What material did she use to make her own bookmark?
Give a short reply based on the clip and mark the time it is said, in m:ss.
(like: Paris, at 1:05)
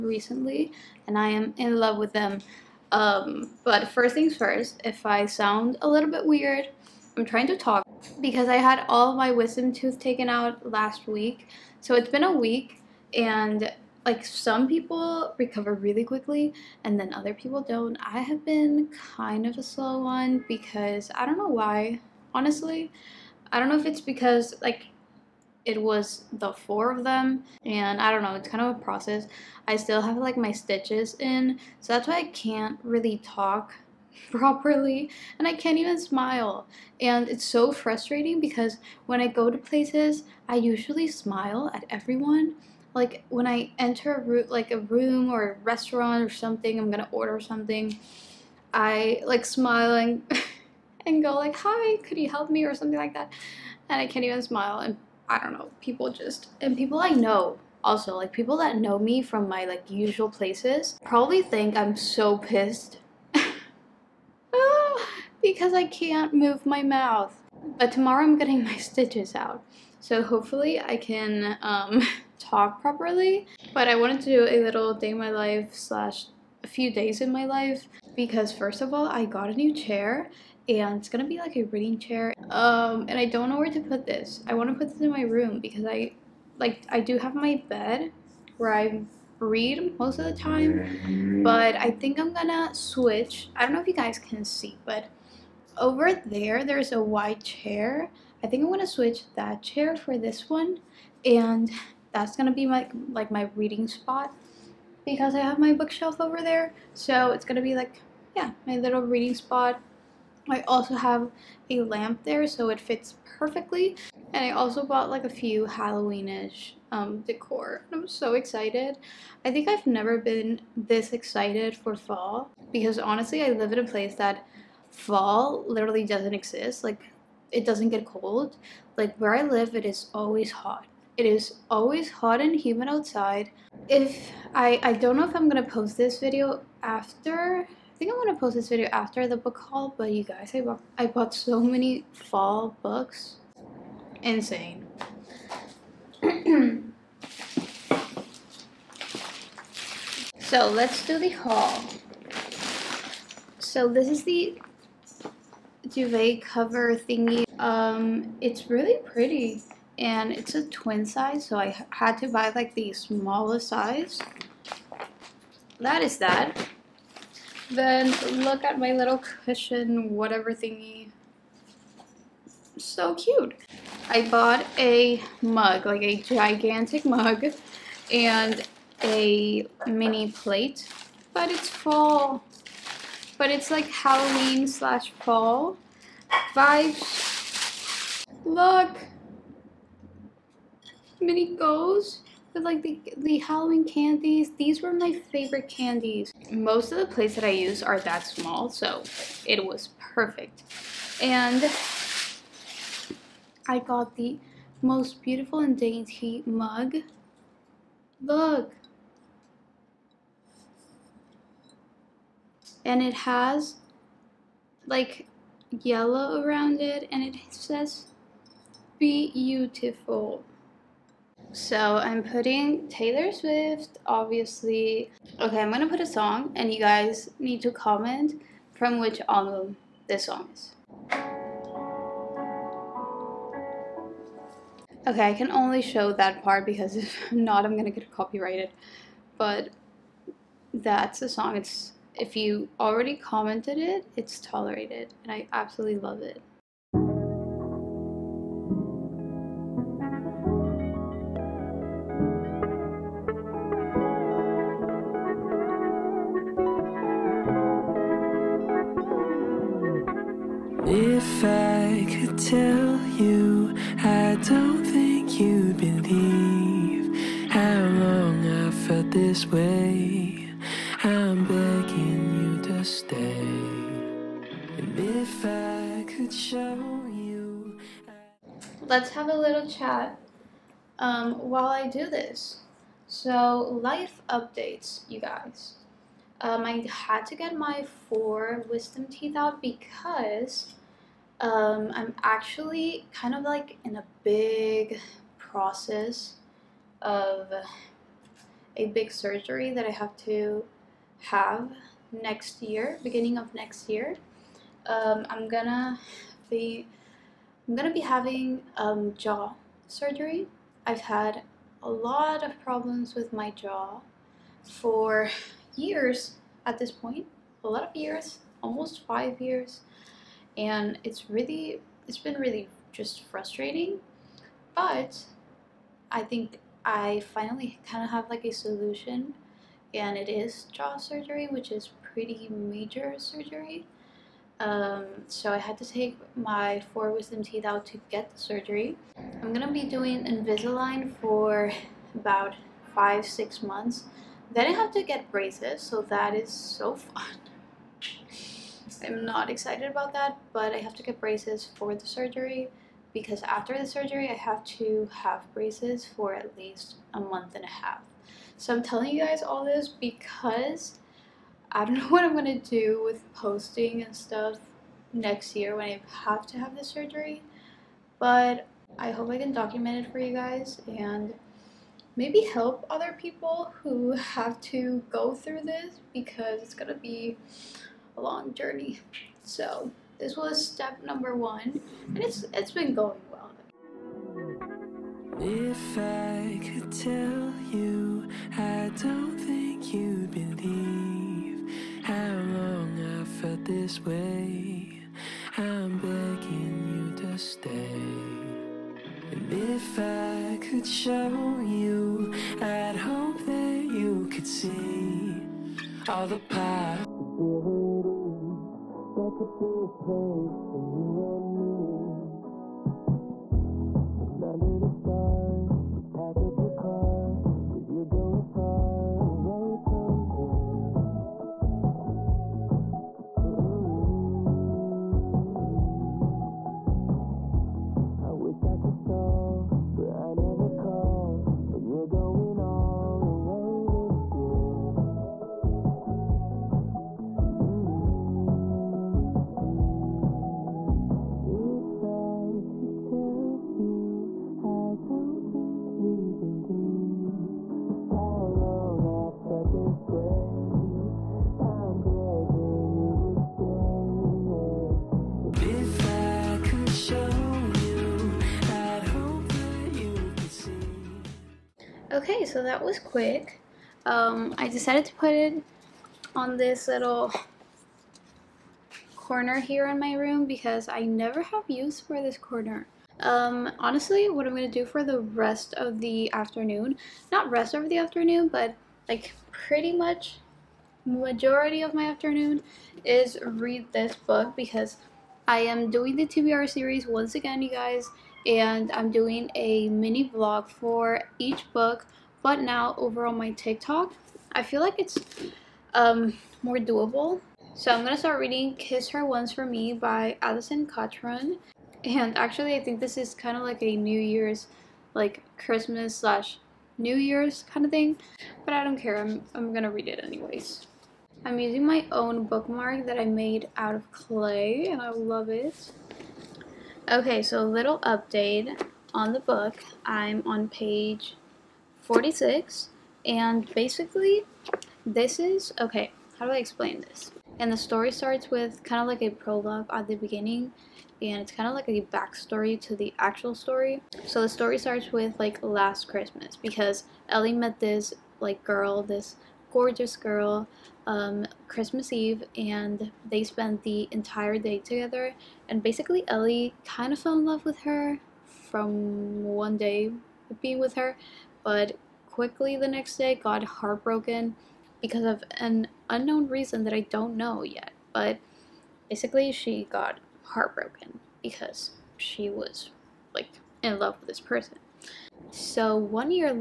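Clay, at 8:34.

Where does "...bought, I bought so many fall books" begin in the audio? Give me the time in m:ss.
2:20.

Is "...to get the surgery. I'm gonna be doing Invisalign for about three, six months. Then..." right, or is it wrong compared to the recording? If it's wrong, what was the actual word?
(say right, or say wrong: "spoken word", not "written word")
wrong: "five", not "three".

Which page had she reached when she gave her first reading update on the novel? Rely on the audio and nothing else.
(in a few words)
46.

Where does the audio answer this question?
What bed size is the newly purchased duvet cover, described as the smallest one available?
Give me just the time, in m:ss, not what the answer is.
2:40.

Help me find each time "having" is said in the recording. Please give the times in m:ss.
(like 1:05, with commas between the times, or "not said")
5:08.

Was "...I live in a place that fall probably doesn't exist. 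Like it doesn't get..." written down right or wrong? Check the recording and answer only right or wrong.
wrong.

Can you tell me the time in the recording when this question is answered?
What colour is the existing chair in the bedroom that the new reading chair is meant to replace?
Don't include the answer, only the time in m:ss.
1:37.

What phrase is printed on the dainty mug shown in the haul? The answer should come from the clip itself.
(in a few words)
Be beautiful.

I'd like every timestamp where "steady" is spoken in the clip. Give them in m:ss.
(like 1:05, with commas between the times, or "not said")
not said.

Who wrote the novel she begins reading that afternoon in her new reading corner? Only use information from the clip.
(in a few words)
Alison Cochrun.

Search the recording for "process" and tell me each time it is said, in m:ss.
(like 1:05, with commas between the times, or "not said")
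0:28, 4:55.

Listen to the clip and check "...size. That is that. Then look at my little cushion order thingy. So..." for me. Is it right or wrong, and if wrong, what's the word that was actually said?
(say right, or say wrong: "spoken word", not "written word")
wrong: "whatever", not "order".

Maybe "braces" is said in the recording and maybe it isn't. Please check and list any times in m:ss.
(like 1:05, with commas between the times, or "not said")
5:45, 5:51, 5:55.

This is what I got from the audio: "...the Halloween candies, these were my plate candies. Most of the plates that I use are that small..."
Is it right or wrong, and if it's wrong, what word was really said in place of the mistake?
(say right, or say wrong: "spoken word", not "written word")
wrong: "favorite", not "plate".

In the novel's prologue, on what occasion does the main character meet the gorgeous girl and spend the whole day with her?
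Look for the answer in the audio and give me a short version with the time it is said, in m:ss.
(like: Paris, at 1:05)
Christmas Eve, at 9:01.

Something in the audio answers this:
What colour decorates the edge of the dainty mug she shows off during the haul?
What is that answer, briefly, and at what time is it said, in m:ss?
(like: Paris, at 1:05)
Yellow, at 3:35.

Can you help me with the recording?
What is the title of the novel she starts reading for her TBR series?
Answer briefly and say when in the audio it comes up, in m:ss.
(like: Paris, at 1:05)
Kiss Her Once for Me, at 8:18.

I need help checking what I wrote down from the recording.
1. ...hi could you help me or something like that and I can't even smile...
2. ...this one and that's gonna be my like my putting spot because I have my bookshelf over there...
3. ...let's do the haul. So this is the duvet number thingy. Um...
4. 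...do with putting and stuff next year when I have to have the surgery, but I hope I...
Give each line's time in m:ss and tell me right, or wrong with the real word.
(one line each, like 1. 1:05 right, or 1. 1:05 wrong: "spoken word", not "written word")
1. 0:51 right
2. 1:40 wrong: "reading", not "putting"
3. 2:30 wrong: "cover", not "number"
4. 6:02 wrong: "posting", not "putting".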